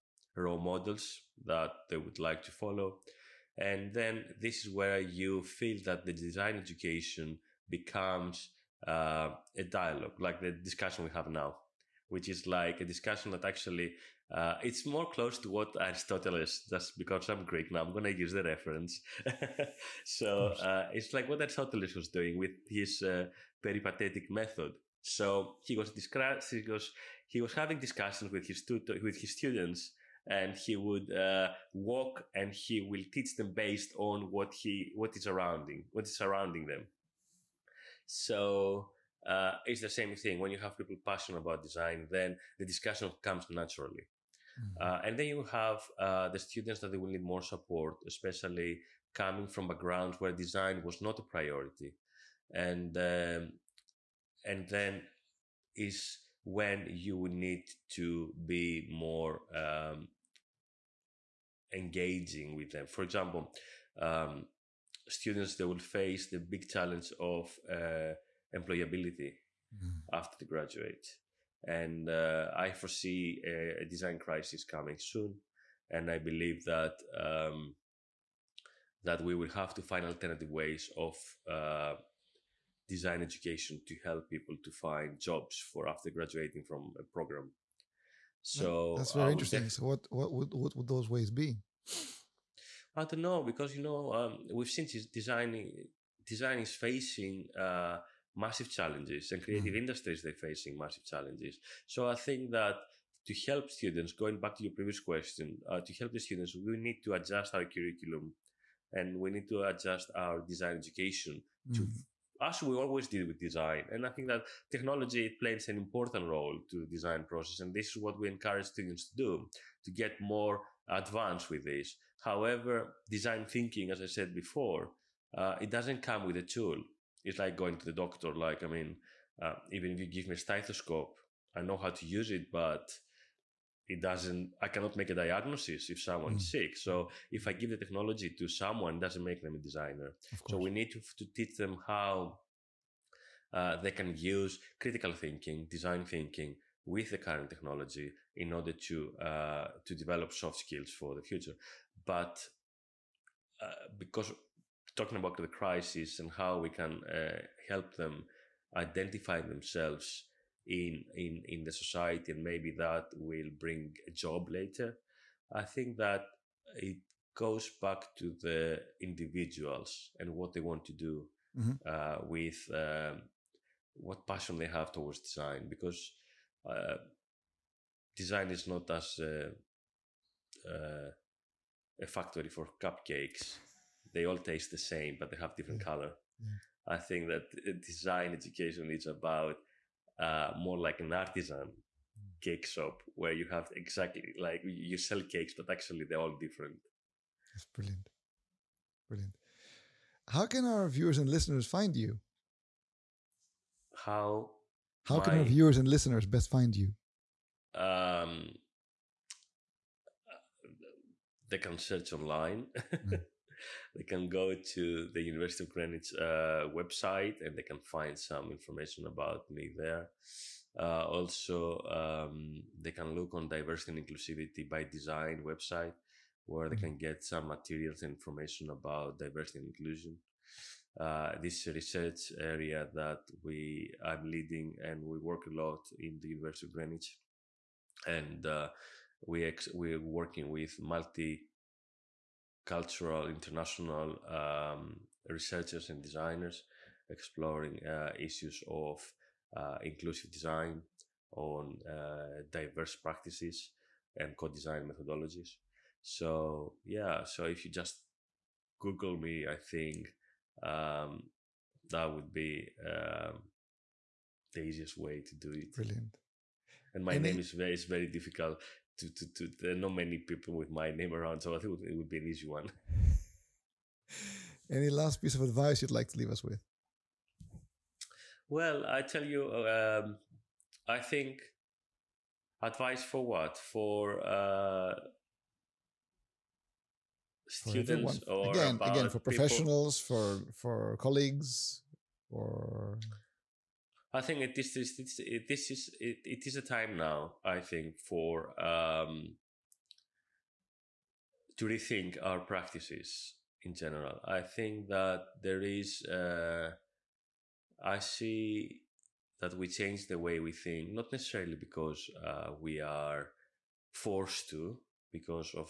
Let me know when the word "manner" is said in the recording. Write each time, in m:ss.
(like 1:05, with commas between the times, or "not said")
not said.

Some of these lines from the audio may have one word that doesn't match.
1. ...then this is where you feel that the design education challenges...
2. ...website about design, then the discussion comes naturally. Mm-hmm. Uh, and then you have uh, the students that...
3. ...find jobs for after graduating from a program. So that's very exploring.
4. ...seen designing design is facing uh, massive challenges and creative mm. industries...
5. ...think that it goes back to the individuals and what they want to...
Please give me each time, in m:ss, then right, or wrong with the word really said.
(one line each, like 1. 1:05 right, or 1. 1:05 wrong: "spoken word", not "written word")
1. 0:03 wrong: "becomes", not "challenges"
2. 0:41 wrong: "passionate", not "website"
3. 1:24 wrong: "interesting", not "exploring"
4. 1:34 right
5. 2:45 right.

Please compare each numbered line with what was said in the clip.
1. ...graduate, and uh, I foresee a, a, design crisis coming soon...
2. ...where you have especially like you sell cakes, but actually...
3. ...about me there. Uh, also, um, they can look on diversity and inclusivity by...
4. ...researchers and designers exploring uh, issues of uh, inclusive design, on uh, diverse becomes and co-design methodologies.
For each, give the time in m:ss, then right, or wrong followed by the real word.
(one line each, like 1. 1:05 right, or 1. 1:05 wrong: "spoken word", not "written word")
1. 1:10 right
2. 3:13 wrong: "exactly", not "especially"
3. 3:39 right
4. 4:05 wrong: "practices", not "becomes".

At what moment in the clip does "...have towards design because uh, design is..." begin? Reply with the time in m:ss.
2:54.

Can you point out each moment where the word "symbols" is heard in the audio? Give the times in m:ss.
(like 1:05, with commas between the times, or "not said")
not said.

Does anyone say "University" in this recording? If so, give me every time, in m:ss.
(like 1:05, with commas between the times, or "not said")
3:35, 3:56.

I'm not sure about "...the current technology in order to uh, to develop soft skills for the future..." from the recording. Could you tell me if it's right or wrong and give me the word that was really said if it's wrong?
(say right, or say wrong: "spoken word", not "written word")
right.